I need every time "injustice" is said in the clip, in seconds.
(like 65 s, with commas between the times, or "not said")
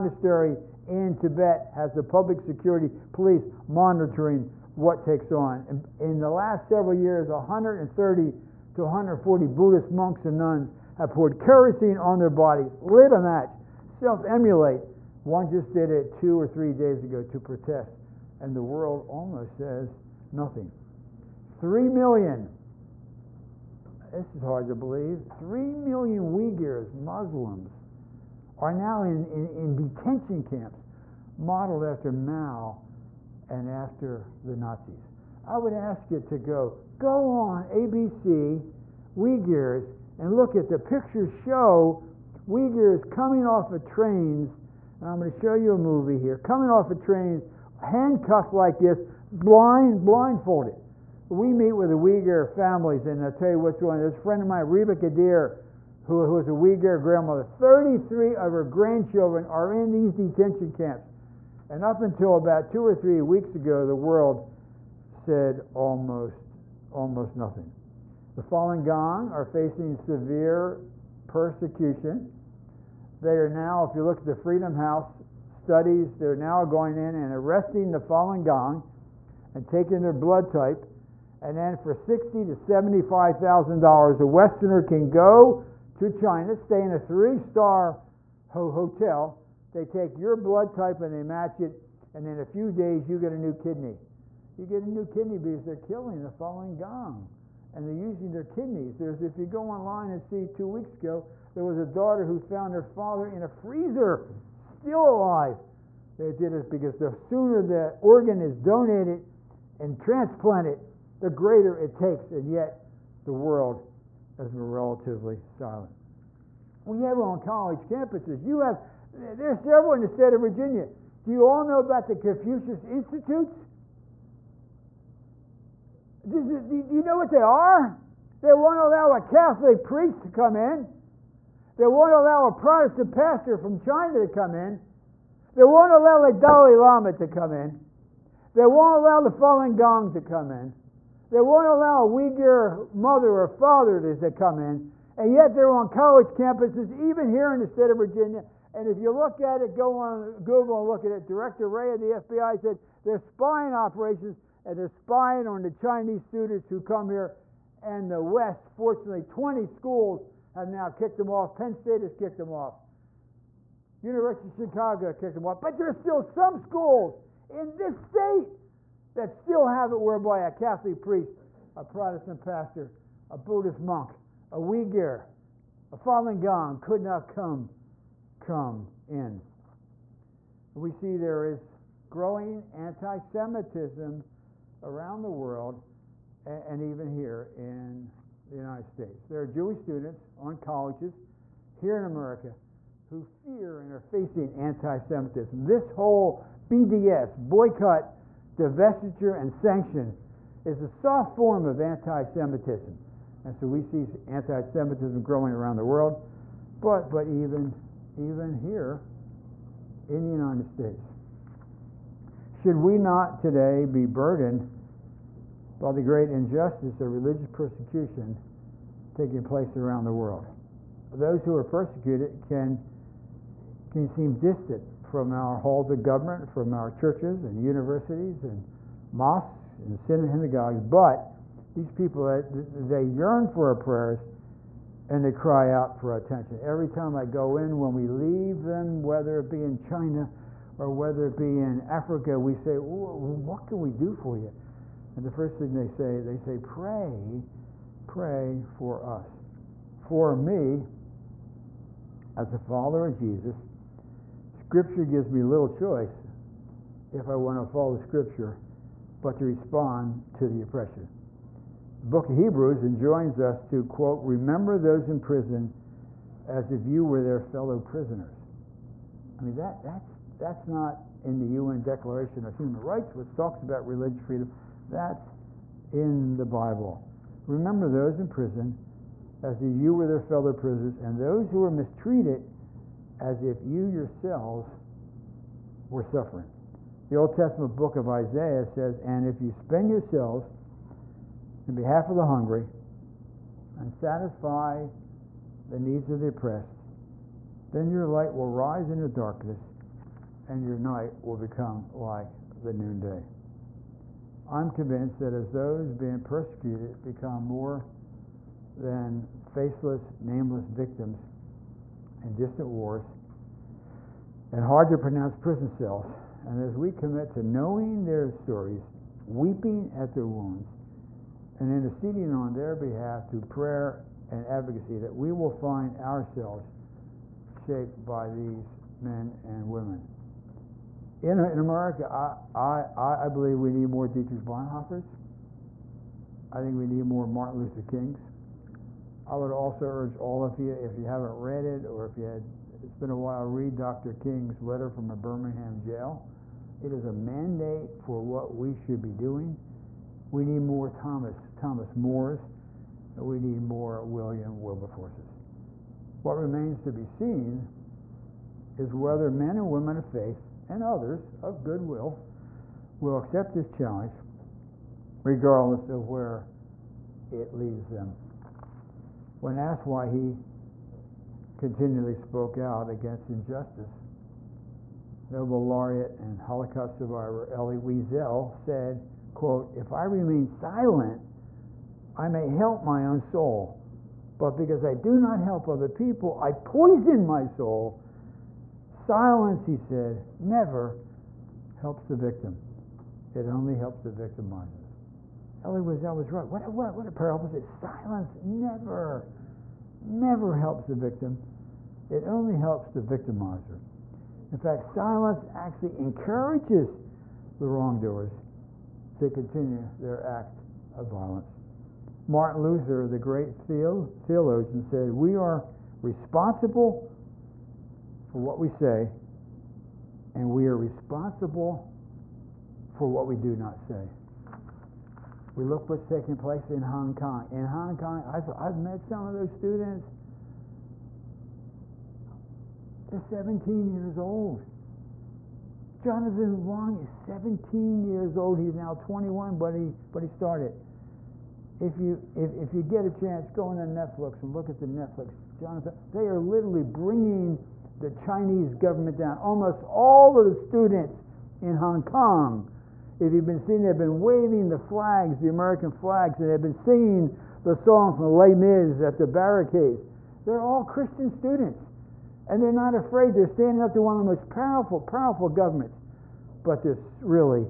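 216 s, 373 s.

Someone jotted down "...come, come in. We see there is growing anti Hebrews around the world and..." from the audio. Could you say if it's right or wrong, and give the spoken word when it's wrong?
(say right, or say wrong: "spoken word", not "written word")
wrong: "Semitism", not "Hebrews".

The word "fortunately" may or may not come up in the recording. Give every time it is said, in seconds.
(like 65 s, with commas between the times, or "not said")
158 s.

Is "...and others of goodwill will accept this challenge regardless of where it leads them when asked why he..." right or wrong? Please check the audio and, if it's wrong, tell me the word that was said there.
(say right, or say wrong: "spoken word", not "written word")
right.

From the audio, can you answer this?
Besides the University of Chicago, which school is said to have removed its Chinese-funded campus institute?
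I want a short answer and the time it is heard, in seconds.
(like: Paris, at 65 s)
Penn State, at 161 s.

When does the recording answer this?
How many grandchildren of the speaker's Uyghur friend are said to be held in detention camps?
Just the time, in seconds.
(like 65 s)
57 s.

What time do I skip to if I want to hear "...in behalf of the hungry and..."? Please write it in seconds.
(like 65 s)
291 s.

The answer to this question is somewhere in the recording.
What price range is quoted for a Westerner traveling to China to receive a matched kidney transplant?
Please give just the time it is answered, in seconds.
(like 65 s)
81 s.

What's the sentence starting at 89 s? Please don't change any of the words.
They take your blood type and they match it, and in a few days you get a new kidney.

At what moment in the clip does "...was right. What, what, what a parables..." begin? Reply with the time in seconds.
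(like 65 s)
396 s.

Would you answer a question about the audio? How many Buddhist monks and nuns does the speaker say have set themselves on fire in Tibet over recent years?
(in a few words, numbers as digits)
130 to 140.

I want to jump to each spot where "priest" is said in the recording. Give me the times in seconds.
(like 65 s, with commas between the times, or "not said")
129 s, 171 s.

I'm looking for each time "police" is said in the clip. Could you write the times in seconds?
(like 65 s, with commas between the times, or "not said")
3 s.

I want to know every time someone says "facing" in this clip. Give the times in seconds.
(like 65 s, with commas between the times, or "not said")
69 s, 194 s.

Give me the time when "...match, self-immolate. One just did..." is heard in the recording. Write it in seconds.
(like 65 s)
13 s.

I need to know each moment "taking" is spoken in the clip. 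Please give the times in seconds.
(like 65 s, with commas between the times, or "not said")
79 s, 219 s, 426 s.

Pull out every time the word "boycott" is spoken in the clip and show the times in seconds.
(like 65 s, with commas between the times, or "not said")
197 s.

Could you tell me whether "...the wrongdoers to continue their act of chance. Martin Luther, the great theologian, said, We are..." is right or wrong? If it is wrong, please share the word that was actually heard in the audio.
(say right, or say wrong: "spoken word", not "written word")
wrong: "violence", not "chance".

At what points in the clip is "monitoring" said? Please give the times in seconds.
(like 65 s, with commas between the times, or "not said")
3 s.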